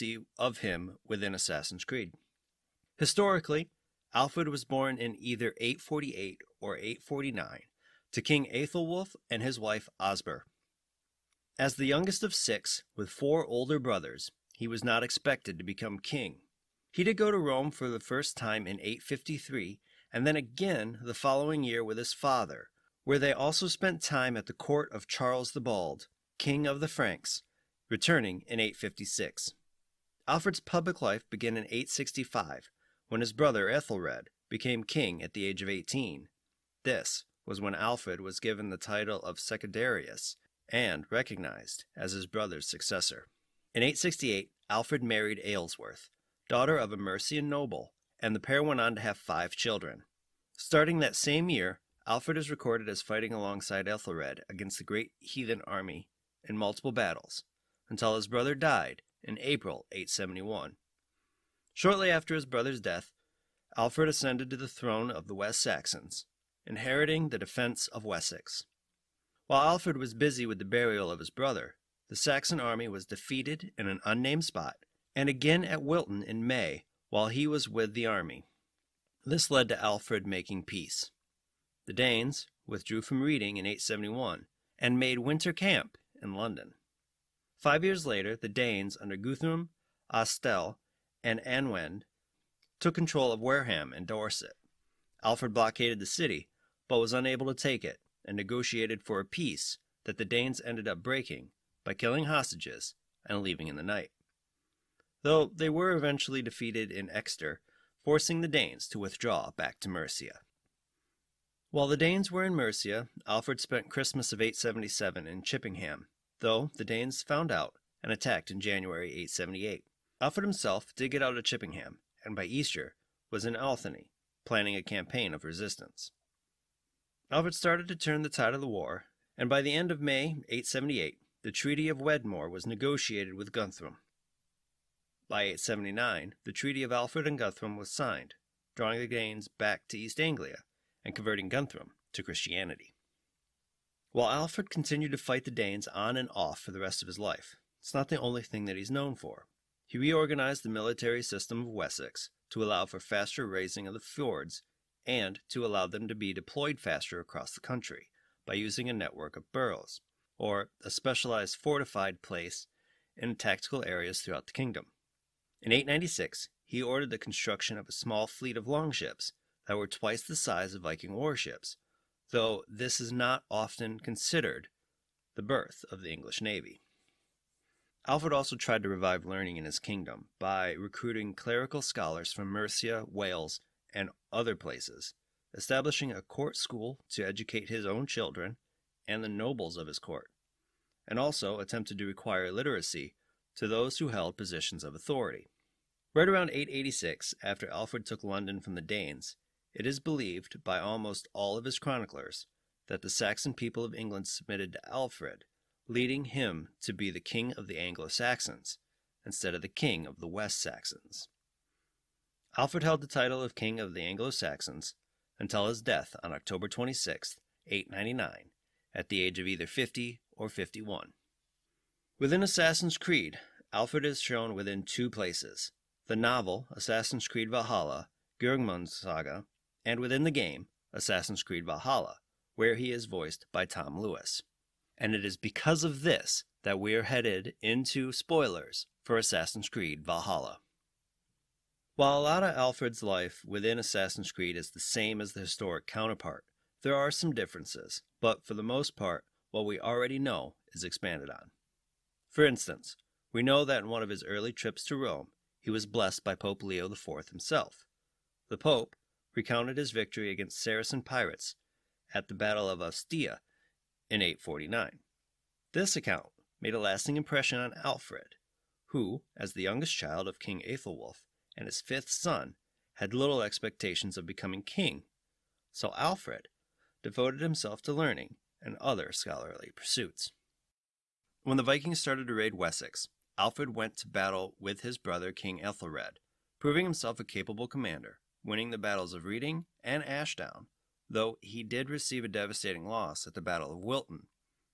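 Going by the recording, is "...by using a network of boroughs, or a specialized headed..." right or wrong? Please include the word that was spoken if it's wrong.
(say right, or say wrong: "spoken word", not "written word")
wrong: "fortified", not "headed".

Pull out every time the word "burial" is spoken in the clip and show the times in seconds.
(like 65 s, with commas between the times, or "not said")
70 s.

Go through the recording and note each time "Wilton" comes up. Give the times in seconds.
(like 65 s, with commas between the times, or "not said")
75 s, 293 s.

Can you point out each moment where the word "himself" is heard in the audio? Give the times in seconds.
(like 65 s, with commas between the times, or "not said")
120 s, 257 s, 277 s, 286 s.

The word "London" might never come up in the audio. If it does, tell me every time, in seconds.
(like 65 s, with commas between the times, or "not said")
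86 s, 198 s.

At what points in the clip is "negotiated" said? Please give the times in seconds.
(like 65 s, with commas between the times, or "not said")
98 s, 132 s.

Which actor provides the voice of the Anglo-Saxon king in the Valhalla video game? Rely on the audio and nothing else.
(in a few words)
Tom Lewis.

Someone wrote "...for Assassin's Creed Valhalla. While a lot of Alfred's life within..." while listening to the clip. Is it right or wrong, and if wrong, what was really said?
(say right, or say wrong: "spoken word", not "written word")
right.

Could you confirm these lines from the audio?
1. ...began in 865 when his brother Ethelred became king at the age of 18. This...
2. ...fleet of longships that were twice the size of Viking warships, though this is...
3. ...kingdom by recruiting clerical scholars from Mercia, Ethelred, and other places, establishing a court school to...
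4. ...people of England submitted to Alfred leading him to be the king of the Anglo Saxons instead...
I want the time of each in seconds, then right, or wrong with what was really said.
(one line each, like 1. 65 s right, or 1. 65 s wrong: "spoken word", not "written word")
1. 31 s right
2. 168 s right
3. 179 s wrong: "Wales", not "Ethelred"
4. 203 s right.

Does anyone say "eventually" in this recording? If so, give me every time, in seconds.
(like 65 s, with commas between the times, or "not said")
105 s.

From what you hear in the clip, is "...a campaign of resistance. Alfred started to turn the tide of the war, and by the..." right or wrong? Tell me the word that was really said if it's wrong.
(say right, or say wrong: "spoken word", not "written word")
right.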